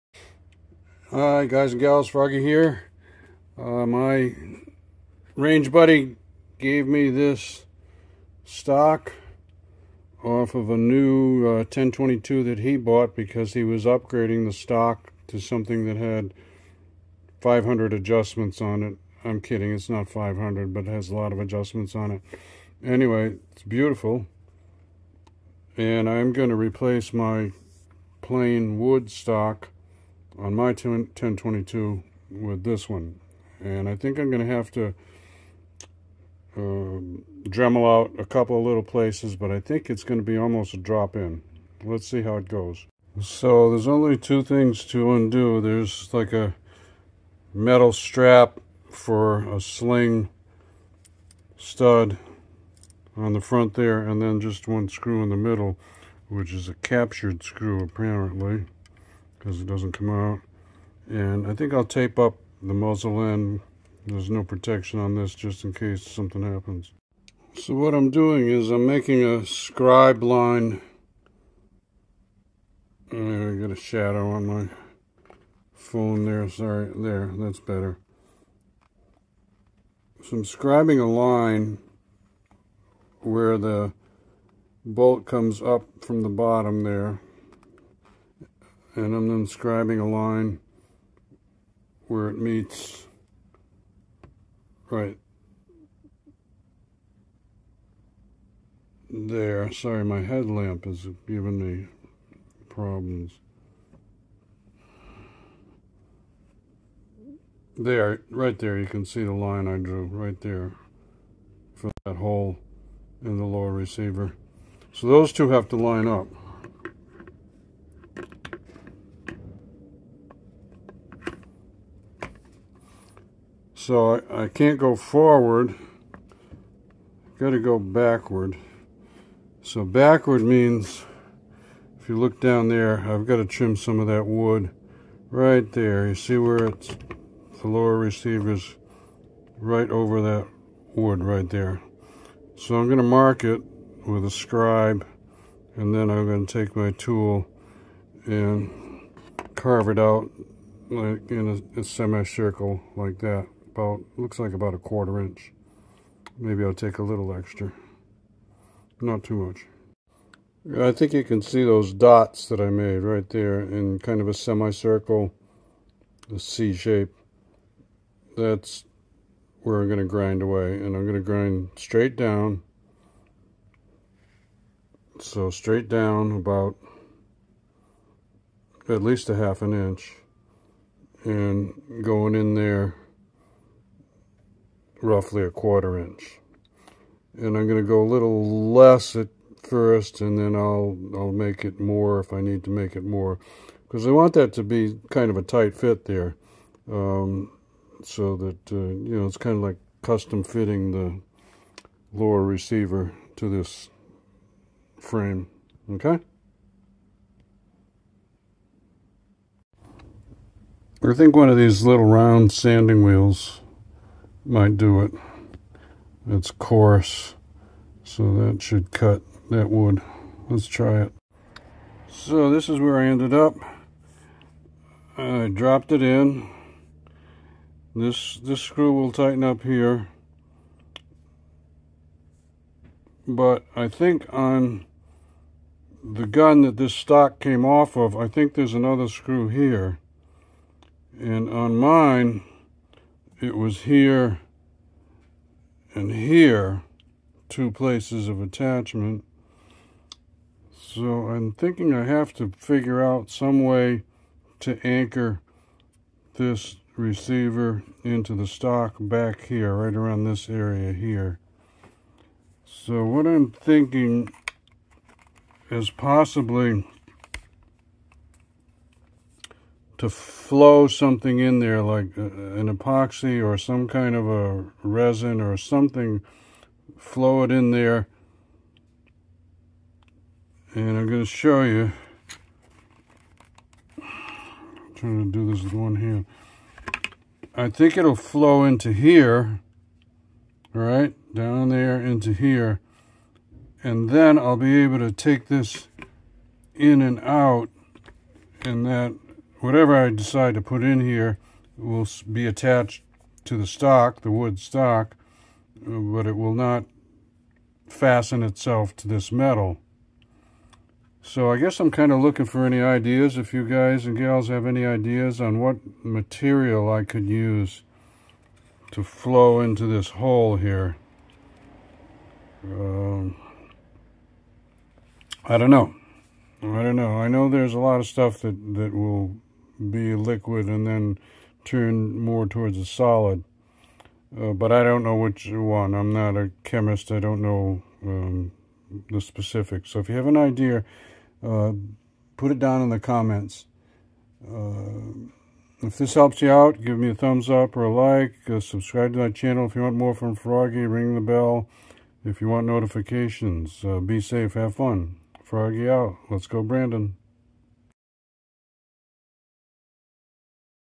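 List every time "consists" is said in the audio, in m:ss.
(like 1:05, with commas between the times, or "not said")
not said.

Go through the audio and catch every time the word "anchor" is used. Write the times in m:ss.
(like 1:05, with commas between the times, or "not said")
4:14.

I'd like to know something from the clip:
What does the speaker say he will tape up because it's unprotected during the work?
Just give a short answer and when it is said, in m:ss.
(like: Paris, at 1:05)
the muzzle end, at 1:02.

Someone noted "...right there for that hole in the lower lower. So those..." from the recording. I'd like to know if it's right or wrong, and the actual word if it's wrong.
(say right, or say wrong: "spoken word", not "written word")
wrong: "receiver", not "lower".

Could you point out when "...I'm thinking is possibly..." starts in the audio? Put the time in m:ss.
4:23.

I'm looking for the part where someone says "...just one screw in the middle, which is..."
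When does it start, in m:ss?
0:54.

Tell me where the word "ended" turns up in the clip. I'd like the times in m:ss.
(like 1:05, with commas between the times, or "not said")
3:43.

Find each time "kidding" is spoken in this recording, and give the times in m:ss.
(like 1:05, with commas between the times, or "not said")
0:19.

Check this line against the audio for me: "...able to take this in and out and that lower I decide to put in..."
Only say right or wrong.
wrong.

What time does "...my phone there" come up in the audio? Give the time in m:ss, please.
1:14.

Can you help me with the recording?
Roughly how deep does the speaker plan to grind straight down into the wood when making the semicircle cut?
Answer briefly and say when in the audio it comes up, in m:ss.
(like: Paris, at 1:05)
half an inch, at 2:59.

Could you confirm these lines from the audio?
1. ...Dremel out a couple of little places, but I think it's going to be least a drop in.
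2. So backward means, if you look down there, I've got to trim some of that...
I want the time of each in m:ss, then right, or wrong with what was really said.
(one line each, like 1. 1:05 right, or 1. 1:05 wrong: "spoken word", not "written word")
1. 0:37 wrong: "almost", not "least"
2. 2:09 right.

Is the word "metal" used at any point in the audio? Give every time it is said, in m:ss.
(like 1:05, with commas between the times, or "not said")
0:47, 5:09.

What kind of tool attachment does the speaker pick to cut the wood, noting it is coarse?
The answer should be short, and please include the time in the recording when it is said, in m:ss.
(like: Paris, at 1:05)
round sanding wheels, at 3:32.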